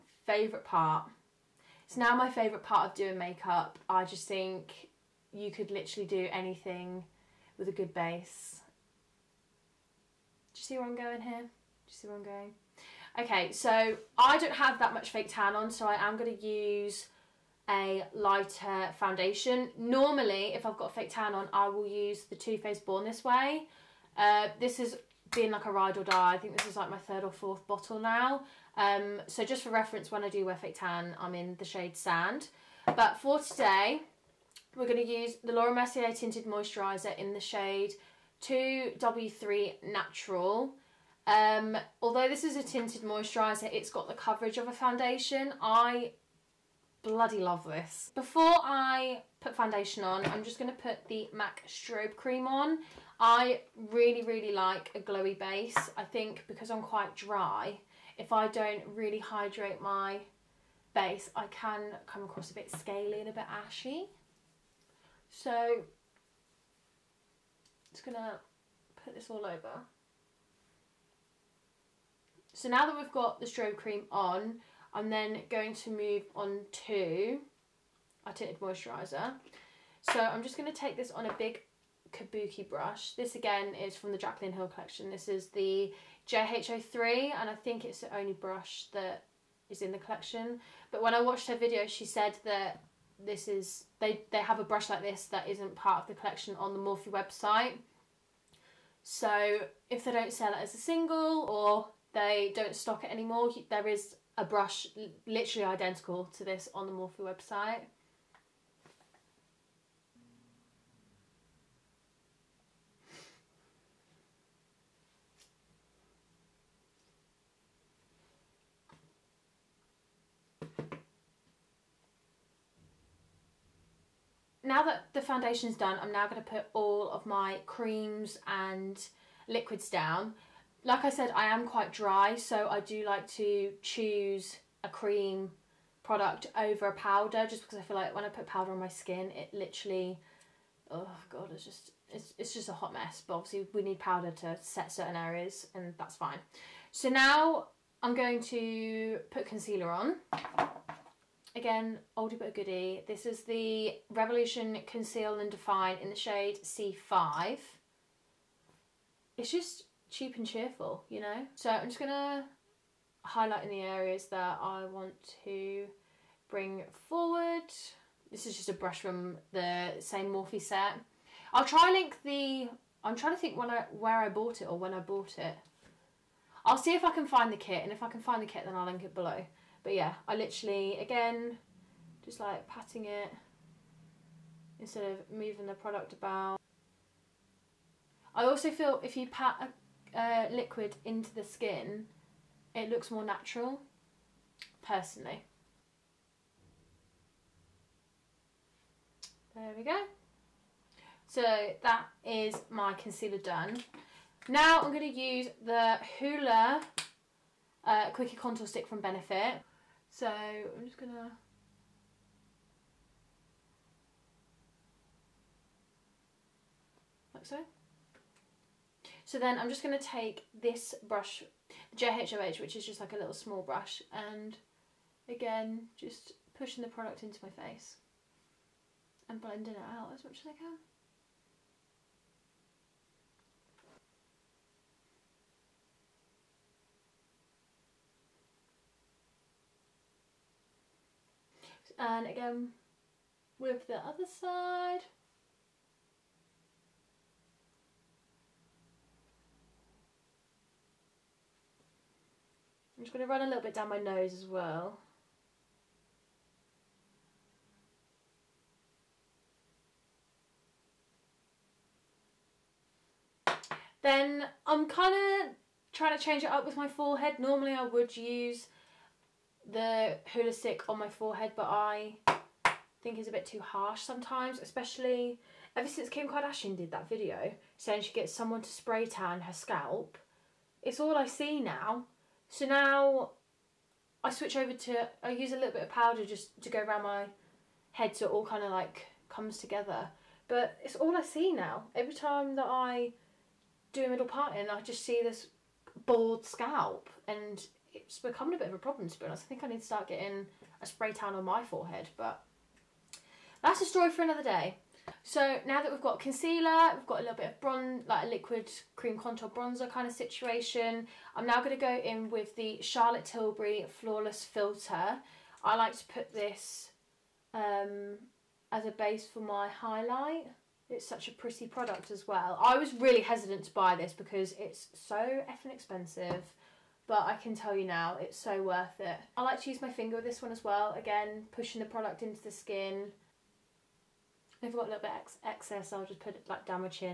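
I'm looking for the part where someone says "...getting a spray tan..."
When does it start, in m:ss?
5:00.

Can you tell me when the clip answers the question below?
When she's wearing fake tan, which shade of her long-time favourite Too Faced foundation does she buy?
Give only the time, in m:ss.
0:31.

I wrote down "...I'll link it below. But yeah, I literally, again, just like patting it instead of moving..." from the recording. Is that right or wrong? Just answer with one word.
right.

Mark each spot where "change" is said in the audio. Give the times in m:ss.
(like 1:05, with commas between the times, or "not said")
4:26.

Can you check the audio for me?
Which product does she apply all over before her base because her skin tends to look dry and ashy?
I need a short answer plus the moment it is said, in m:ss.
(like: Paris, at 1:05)
MAC strobe cream, at 0:51.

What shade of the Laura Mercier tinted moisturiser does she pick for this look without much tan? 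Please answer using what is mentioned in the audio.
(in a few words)
2W3 Natural.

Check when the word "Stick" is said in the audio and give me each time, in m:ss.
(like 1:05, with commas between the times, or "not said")
3:28, 4:30.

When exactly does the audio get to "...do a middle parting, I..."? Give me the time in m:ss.
4:53.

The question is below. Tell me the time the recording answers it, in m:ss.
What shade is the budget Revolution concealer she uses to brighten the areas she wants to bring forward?
2:36.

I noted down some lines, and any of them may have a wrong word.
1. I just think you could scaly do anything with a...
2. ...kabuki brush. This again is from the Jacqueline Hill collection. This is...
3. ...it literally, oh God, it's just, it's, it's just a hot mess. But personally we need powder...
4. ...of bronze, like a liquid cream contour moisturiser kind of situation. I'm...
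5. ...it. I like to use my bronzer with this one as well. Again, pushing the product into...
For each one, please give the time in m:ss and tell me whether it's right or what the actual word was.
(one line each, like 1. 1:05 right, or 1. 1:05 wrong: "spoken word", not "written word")
1. 0:03 wrong: "literally", not "scaly"
2. 1:22 right
3. 2:19 wrong: "obviously", not "personally"
4. 5:07 wrong: "bronzer", not "moisturiser"
5. 5:28 wrong: "finger", not "bronzer".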